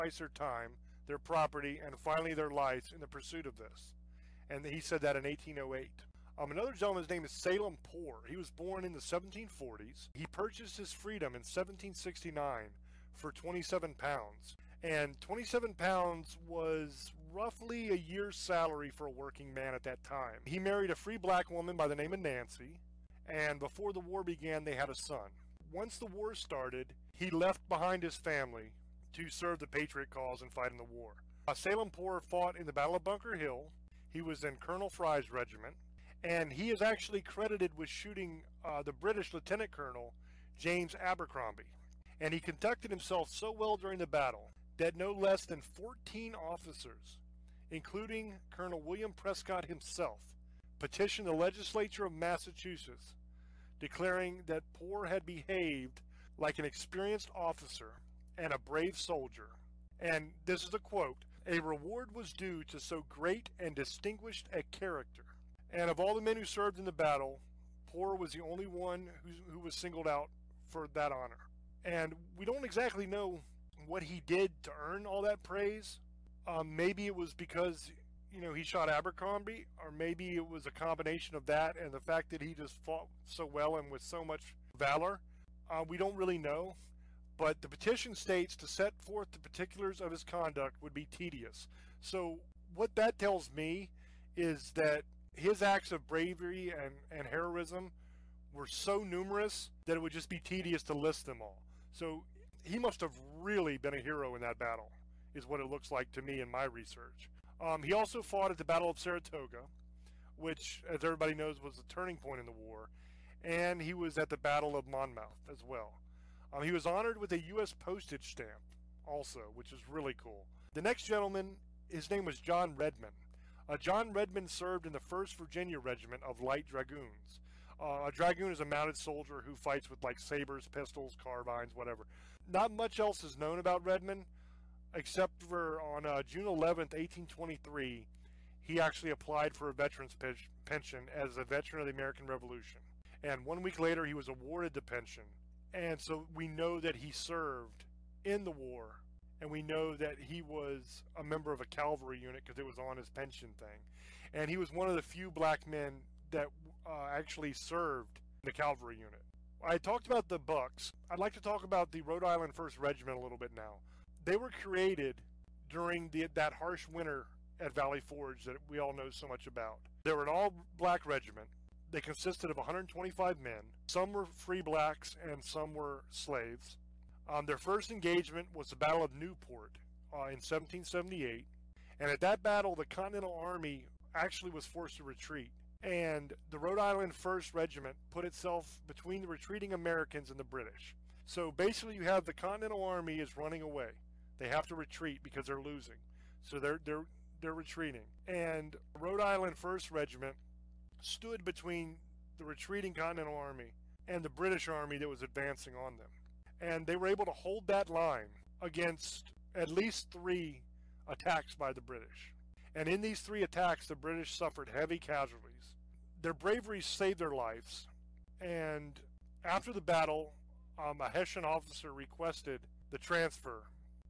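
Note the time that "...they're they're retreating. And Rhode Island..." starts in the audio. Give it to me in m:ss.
3:16.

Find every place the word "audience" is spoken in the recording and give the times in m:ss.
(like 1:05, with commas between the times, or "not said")
not said.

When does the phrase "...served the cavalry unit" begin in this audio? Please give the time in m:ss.
2:37.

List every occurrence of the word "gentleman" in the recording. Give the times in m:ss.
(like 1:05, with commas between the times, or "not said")
0:06, 2:01.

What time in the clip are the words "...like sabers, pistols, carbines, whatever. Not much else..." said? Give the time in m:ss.
2:10.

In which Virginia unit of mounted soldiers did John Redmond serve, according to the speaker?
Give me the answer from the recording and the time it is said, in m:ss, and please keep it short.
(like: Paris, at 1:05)
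1st Virginia Regiment of Light Dragoons, at 2:04.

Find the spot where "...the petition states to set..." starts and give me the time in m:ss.
1:27.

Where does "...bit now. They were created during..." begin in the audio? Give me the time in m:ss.
2:43.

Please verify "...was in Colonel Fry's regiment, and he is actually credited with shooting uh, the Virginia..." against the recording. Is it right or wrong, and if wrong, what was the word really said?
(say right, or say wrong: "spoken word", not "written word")
wrong: "British", not "Virginia".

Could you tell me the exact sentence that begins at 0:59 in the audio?
And this is a quote, a reward was due to so great and distinguished a character.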